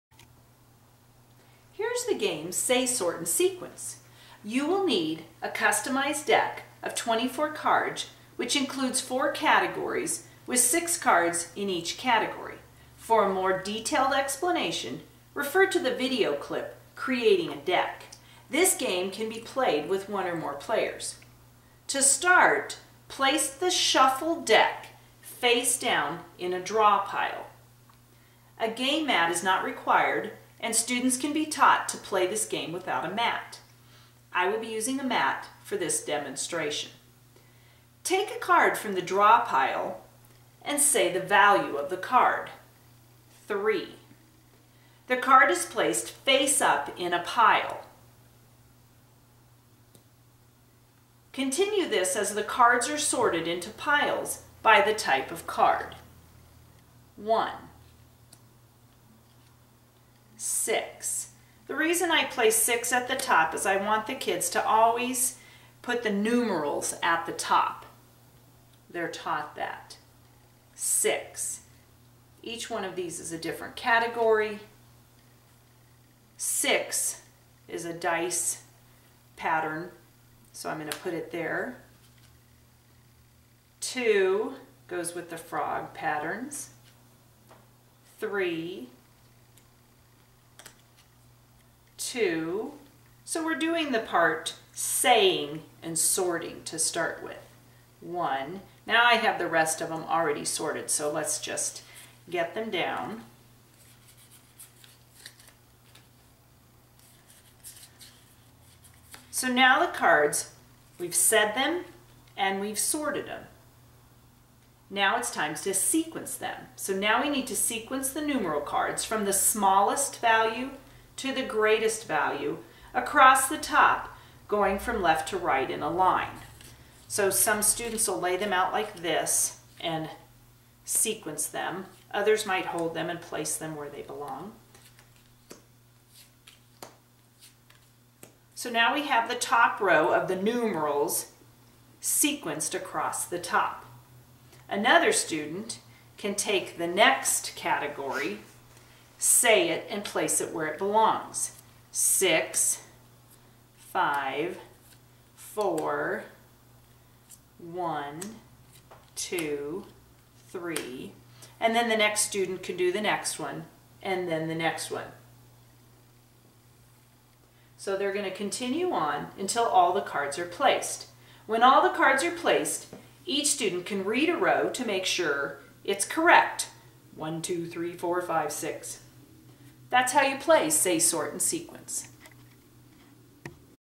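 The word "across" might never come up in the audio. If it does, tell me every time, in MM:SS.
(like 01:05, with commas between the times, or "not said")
02:02, 02:22.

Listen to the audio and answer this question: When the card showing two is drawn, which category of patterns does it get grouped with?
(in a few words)
frog patterns.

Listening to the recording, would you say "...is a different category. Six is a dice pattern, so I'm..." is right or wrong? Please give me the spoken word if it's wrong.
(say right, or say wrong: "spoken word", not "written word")
right.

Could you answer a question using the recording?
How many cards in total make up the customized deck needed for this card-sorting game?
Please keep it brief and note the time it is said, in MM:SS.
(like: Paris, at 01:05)
24, at 00:06.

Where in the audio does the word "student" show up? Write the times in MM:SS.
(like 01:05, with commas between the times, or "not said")
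00:30, 02:07, 02:25, 02:42, 02:53.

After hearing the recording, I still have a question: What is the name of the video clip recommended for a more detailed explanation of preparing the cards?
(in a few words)
Creating a Deck.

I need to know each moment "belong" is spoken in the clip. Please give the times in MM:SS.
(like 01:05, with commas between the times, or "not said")
02:14, 02:30.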